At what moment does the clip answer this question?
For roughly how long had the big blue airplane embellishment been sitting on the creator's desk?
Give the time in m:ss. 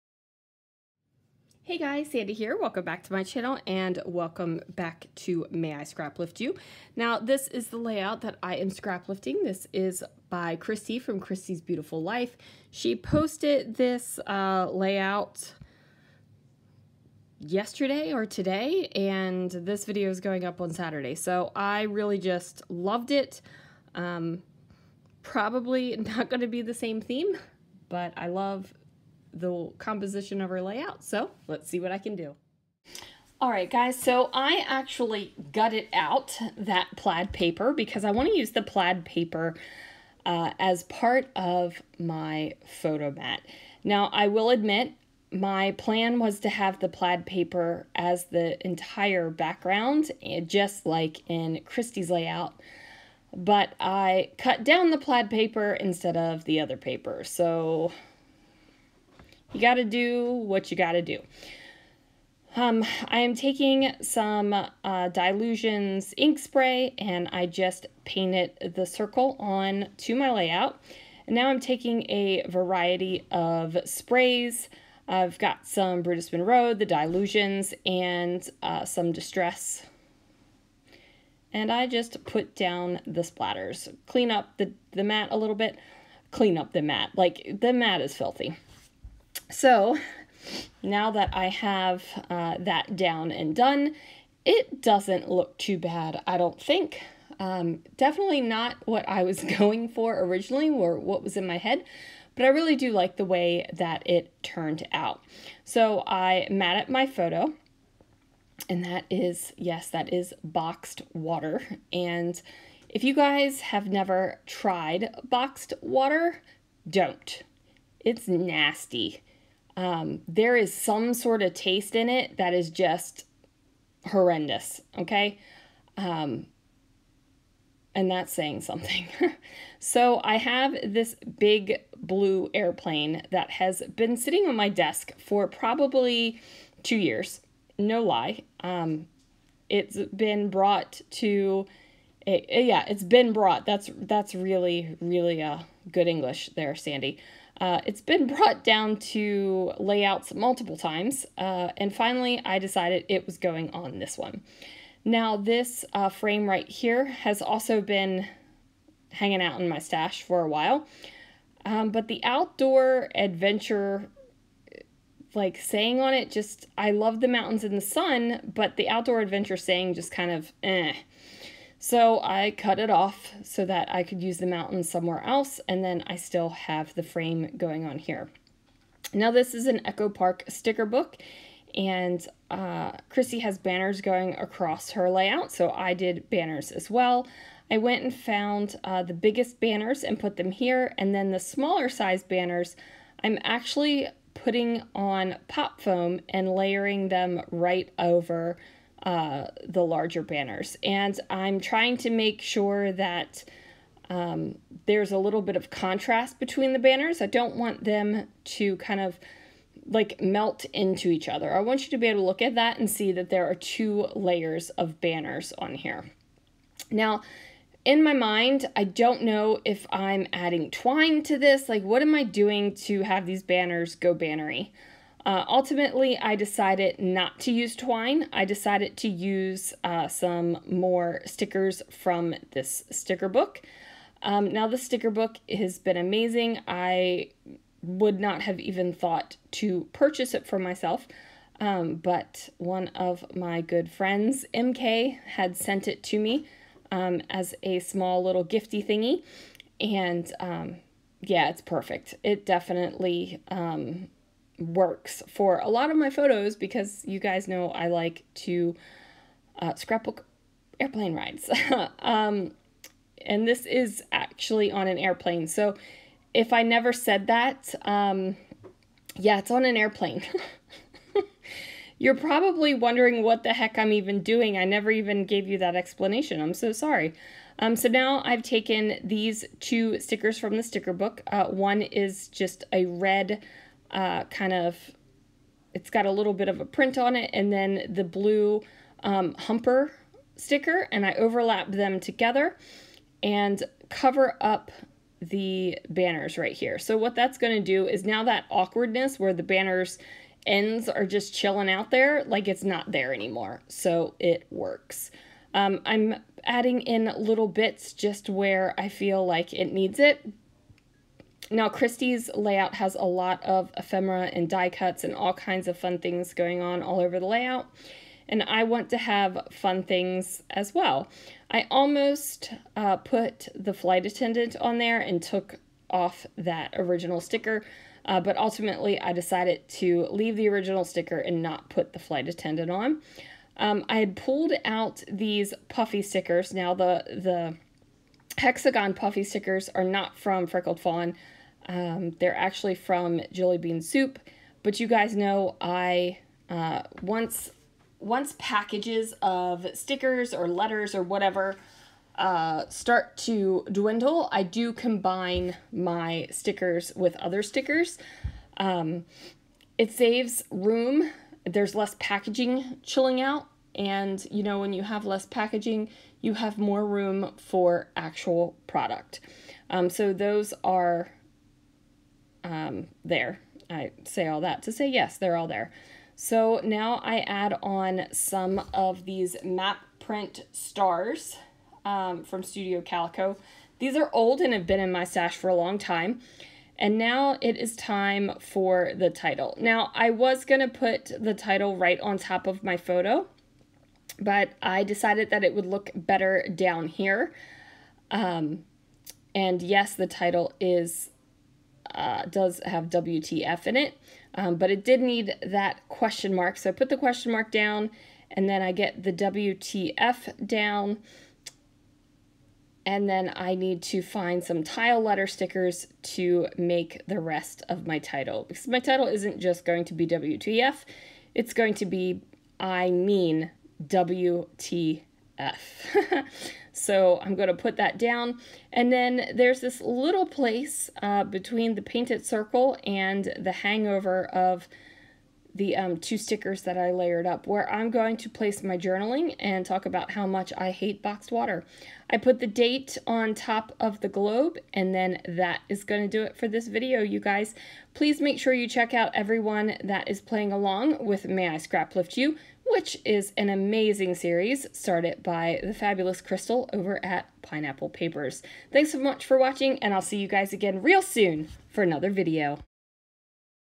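2:16.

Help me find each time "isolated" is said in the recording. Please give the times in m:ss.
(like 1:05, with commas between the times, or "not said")
not said.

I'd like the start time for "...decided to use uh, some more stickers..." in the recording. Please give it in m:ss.
3:48.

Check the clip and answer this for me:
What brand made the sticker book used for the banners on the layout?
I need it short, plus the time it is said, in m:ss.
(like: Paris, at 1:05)
Echo Park, at 2:59.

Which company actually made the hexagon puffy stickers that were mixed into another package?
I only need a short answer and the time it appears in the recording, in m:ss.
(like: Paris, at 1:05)
Jillibean Soup, at 5:43.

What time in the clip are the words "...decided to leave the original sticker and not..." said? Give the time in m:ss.
5:29.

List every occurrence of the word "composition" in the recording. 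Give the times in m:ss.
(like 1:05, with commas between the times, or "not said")
0:29.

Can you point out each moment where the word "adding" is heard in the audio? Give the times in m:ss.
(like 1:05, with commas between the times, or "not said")
3:40, 5:06.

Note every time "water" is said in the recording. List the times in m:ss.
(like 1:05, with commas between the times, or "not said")
1:51, 1:55, 7:21.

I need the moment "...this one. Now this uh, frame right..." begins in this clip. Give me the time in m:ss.
2:33.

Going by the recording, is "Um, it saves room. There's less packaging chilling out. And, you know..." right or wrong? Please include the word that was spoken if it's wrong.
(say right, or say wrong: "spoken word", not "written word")
right.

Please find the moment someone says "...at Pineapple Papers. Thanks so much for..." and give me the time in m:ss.
7:37.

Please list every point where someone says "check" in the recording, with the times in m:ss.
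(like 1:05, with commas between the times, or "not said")
7:28.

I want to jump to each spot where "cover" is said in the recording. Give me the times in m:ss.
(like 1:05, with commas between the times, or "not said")
4:53.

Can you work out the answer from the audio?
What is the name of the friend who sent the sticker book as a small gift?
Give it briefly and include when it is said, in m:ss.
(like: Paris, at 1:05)
MK, at 4:04.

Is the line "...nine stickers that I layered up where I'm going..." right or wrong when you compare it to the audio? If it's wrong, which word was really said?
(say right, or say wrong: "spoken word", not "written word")
wrong: "two", not "nine".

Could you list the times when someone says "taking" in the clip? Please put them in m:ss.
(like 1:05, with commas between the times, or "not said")
1:03, 1:11.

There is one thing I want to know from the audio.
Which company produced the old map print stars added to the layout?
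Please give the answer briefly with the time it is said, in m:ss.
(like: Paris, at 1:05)
Studio Calico, at 6:22.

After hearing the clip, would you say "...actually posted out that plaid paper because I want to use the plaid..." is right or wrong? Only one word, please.
wrong.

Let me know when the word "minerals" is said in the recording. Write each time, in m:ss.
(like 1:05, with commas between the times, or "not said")
not said.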